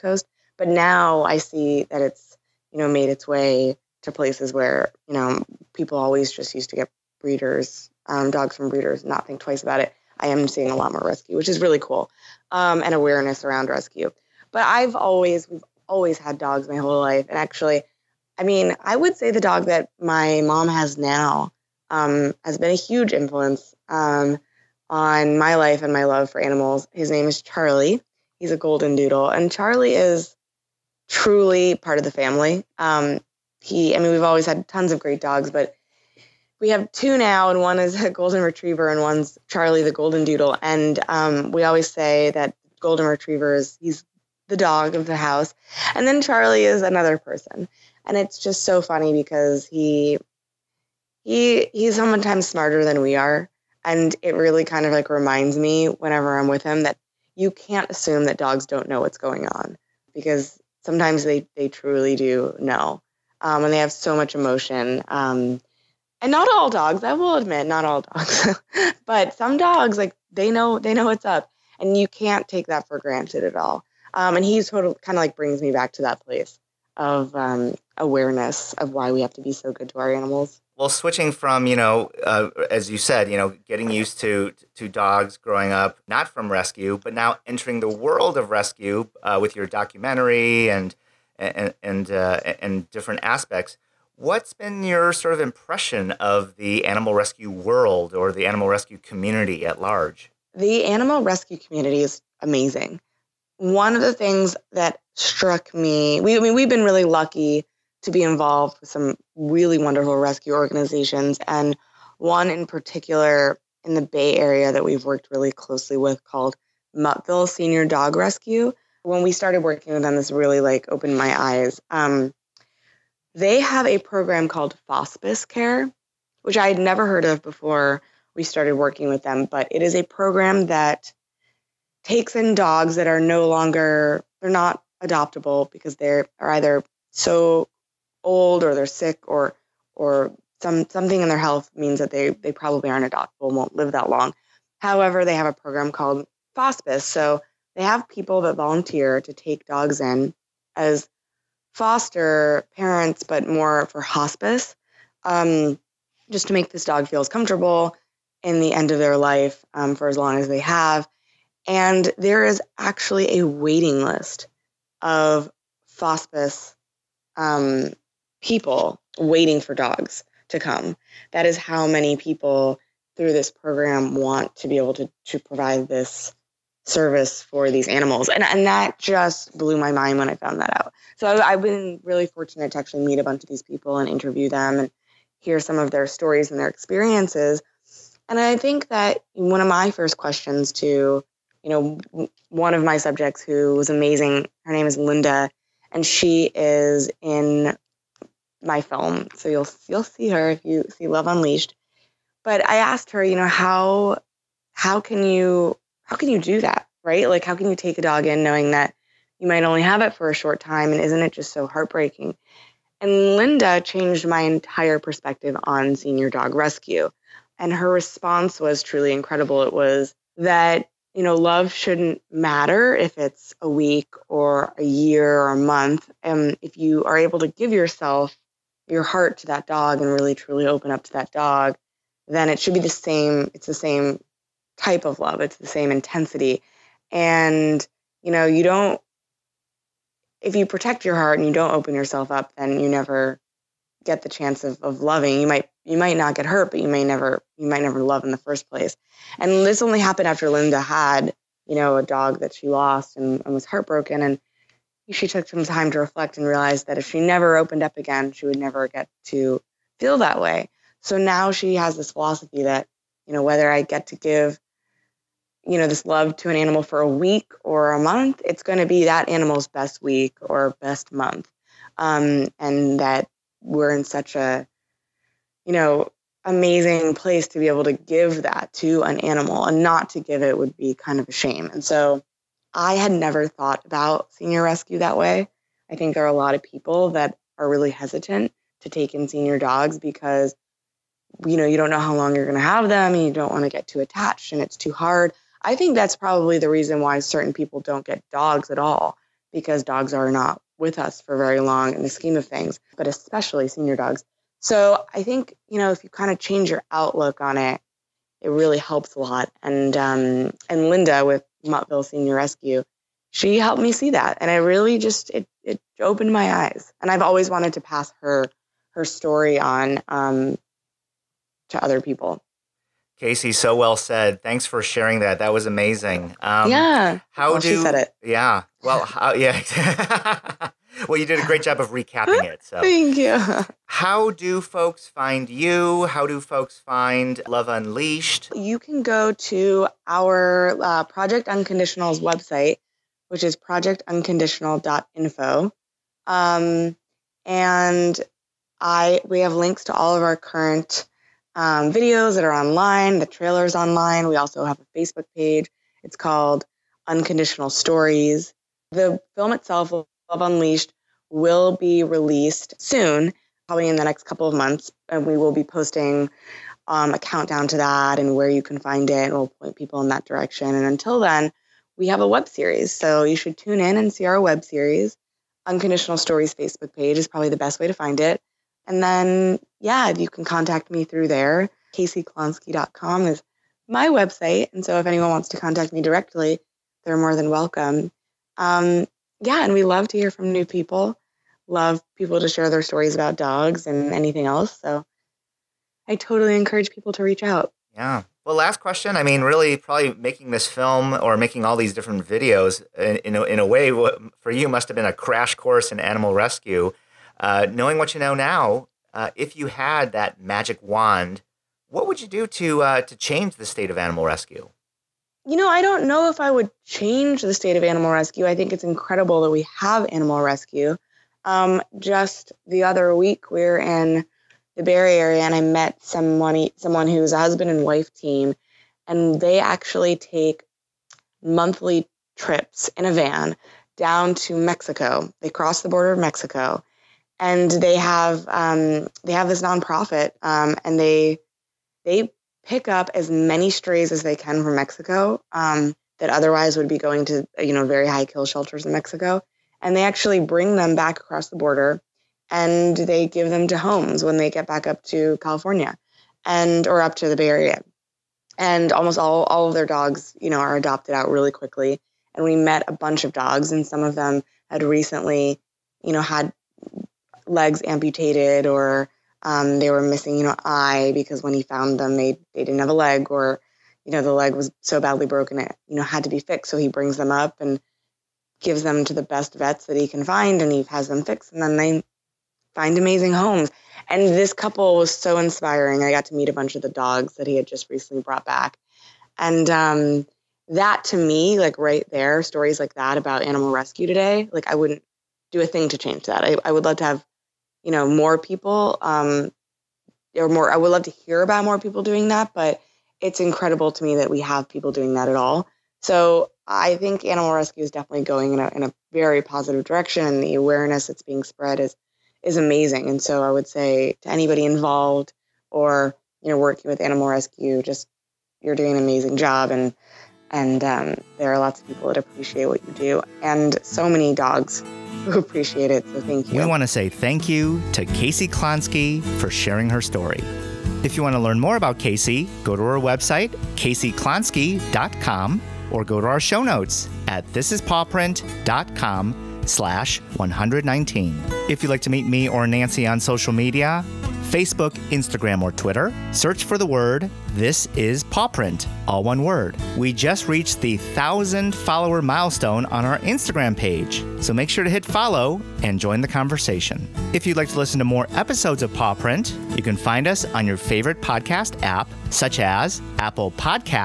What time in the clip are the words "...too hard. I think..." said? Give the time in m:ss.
4:54.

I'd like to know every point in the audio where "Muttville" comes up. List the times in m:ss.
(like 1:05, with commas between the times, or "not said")
1:56, 5:11.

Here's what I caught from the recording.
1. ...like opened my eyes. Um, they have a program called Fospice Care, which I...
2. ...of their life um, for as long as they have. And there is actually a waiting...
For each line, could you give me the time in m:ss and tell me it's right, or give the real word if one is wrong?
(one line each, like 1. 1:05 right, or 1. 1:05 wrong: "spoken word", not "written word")
1. 2:00 right
2. 2:38 right.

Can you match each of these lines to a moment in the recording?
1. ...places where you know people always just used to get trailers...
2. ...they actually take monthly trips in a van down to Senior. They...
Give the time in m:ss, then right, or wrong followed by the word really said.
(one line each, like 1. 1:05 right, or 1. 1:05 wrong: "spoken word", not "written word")
1. 0:04 wrong: "breeders", not "trailers"
2. 7:09 wrong: "Mexico", not "Senior".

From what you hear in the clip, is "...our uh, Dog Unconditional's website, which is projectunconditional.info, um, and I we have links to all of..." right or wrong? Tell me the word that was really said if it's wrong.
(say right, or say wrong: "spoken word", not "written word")
wrong: "Project", not "Dog".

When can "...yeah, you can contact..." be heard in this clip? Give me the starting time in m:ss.
6:19.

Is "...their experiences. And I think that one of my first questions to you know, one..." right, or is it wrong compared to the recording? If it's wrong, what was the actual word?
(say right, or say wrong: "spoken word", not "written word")
right.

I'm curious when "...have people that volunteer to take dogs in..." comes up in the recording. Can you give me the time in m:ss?
2:27.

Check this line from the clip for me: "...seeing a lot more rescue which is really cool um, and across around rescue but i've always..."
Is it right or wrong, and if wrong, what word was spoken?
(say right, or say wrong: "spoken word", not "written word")
wrong: "awareness", not "across".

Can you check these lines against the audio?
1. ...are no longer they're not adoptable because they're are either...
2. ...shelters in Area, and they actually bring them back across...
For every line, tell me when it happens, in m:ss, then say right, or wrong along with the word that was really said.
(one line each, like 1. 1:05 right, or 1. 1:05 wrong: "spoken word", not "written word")
1. 2:13 right
2. 7:28 wrong: "Mexico", not "Area".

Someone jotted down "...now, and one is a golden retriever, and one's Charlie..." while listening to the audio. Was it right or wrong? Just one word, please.
right.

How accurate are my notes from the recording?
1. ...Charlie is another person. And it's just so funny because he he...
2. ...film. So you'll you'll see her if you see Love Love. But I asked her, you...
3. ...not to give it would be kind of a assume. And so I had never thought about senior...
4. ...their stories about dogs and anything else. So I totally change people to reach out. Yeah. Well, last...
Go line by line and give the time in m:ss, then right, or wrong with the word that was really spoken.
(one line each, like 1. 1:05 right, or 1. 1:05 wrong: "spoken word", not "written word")
1. 0:46 right
2. 3:18 wrong: "Unleashed", not "Love"
3. 4:39 wrong: "shame", not "assume"
4. 6:32 wrong: "encourage", not "change".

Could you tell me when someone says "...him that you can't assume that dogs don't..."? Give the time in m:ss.
0:56.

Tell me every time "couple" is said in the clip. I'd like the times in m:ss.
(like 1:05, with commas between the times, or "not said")
6:04, 8:04.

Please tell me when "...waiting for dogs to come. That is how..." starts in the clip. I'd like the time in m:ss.
2:49.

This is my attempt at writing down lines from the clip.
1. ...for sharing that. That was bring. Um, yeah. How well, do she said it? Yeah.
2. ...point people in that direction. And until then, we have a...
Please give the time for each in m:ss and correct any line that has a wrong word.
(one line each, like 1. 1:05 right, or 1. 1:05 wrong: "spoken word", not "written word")
1. 5:24 wrong: "amazing", not "bring"
2. 6:09 right.